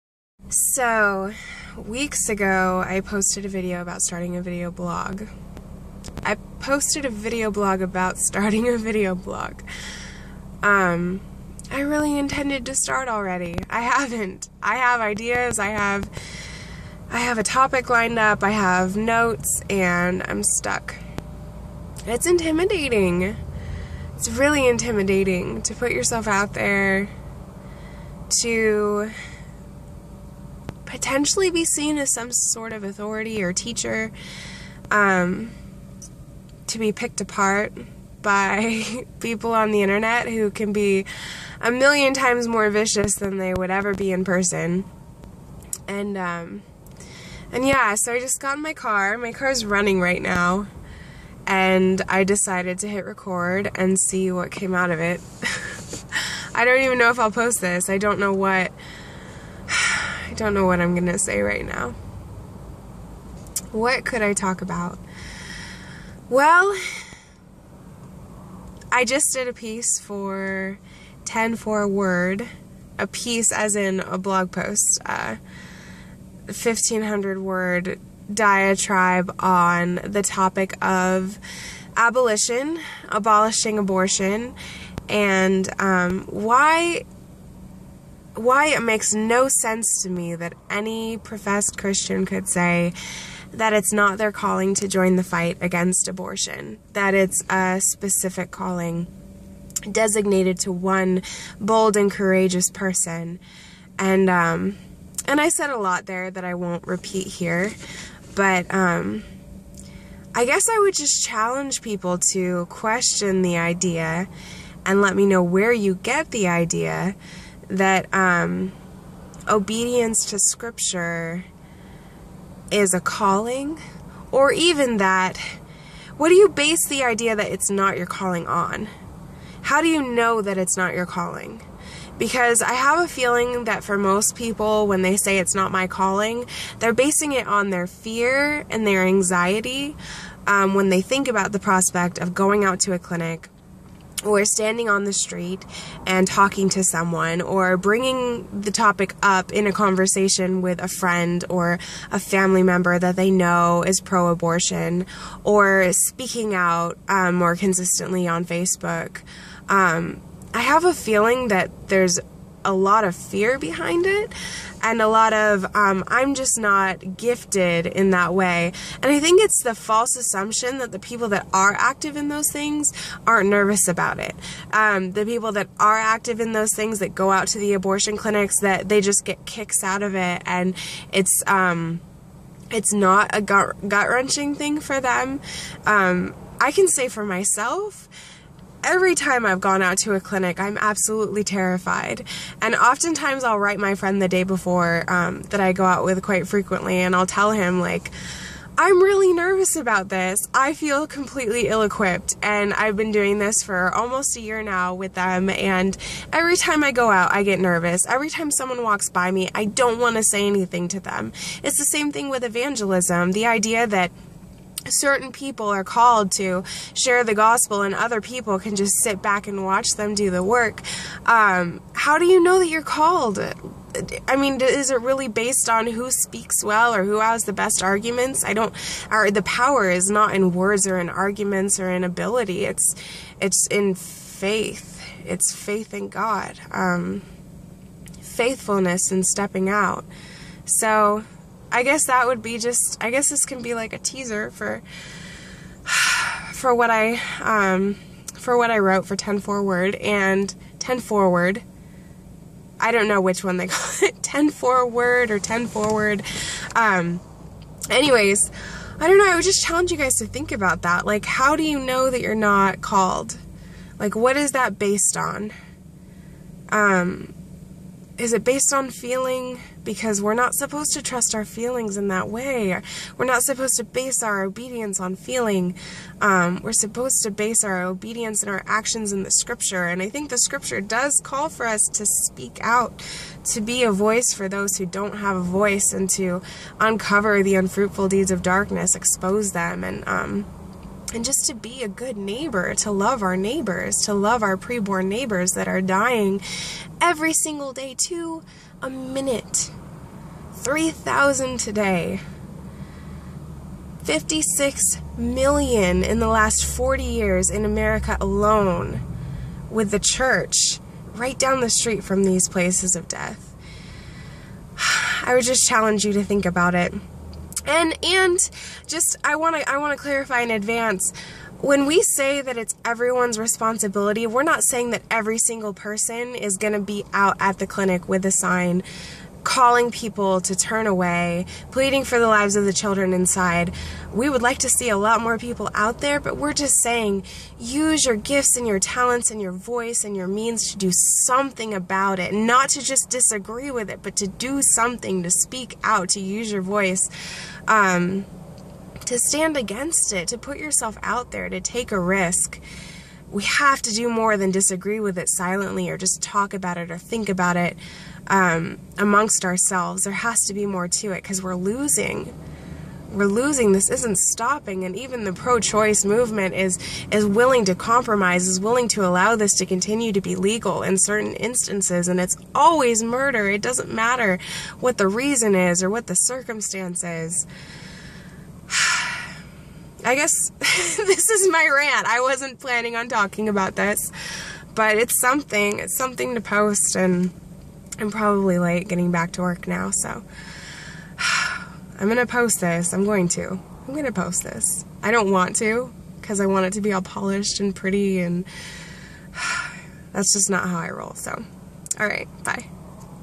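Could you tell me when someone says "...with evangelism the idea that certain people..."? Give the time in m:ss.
3:32.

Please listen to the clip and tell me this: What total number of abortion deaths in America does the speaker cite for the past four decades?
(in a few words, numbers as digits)
56 million.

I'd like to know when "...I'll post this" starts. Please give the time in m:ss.
0:57.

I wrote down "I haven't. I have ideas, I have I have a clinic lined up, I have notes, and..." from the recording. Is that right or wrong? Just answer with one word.
wrong.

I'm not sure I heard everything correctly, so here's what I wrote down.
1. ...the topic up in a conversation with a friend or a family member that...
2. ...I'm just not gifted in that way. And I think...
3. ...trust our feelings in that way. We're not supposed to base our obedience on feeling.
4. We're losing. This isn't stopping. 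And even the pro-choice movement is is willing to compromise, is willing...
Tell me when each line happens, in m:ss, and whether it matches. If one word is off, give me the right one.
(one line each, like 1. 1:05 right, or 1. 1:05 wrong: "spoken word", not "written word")
1. 2:28 right
2. 2:46 right
3. 4:31 right
4. 6:03 right.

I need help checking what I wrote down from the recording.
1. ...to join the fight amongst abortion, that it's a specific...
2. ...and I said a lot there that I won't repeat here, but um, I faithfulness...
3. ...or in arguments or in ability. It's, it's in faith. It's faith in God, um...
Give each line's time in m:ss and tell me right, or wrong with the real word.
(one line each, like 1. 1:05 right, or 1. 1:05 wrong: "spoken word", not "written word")
1. 1:34 wrong: "against", not "amongst"
2. 1:45 wrong: "guess", not "faithfulness"
3. 3:50 right.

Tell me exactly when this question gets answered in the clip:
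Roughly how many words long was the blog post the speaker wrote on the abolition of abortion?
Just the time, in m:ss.
1:16.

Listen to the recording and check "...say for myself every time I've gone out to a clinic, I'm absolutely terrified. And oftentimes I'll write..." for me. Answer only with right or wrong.
right.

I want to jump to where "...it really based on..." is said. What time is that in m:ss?
3:44.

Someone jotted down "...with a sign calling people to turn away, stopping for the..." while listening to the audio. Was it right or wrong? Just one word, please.
wrong.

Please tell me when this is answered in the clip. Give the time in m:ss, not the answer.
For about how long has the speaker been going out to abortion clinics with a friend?
3:23.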